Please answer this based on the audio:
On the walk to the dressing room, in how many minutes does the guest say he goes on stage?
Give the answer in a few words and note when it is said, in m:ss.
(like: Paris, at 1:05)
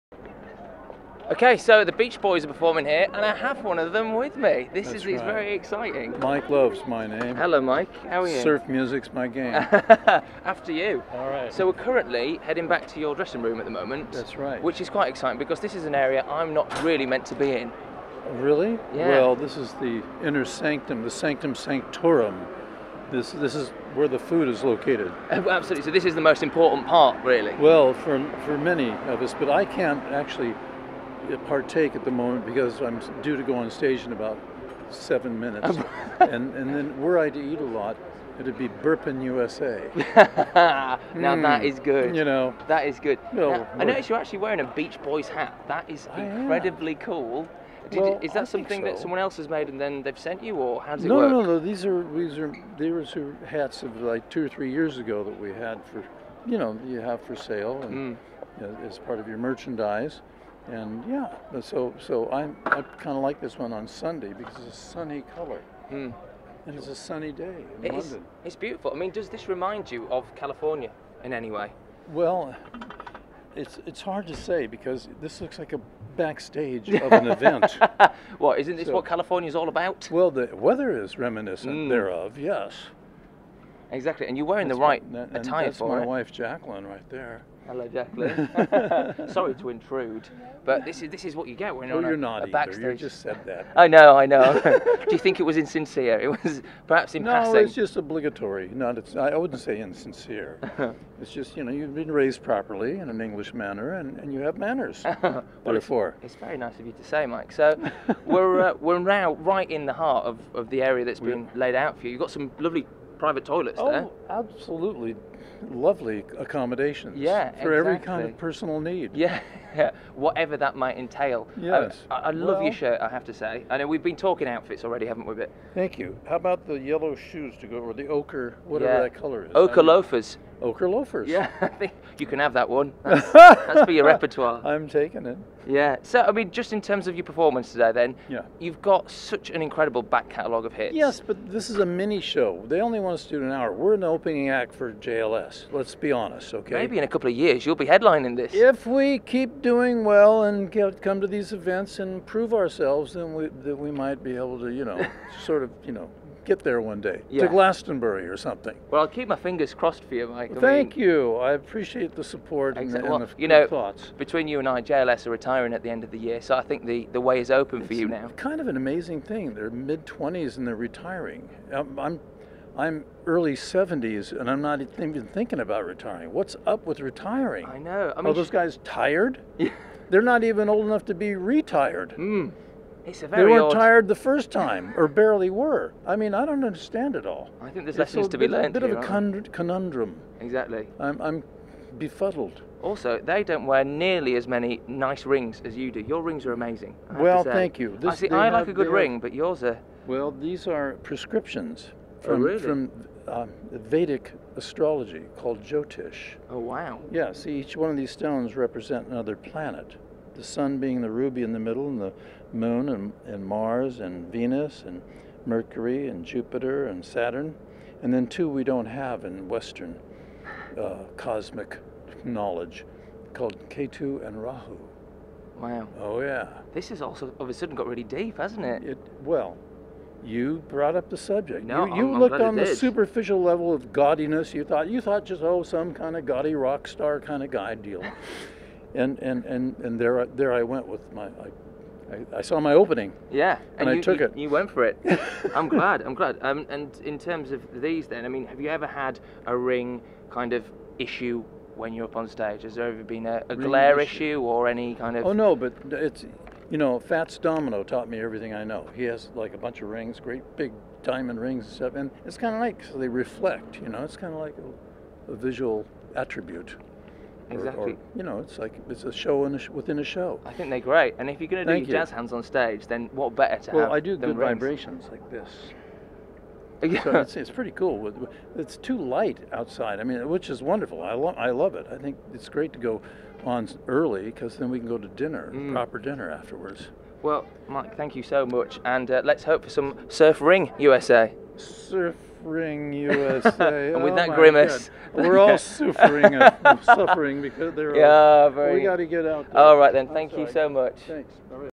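7, at 0:34.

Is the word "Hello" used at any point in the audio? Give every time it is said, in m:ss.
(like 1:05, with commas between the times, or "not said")
0:07, 1:27.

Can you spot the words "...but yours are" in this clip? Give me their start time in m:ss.
3:19.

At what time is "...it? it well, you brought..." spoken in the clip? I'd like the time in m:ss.
3:48.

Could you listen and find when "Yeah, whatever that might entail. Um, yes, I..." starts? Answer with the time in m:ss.
1:59.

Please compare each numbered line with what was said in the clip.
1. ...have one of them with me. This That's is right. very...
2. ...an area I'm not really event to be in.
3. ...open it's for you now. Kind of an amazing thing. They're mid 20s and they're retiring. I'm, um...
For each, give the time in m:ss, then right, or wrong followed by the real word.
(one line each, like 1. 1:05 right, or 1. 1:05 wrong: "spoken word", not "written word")
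1. 0:03 right
2. 0:15 wrong: "meant", not "event"
3. 2:47 right.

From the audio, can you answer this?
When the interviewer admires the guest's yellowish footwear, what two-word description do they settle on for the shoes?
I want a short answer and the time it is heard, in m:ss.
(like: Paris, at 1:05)
Ochre loafers, at 2:10.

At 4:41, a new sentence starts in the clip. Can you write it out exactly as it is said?
I think it's great to go on early because then we can go to dinner, mm.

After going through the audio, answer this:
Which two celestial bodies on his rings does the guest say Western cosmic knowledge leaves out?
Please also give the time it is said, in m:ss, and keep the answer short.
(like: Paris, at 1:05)
Ketu and Rahu, at 3:43.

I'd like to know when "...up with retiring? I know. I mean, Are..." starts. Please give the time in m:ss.
2:56.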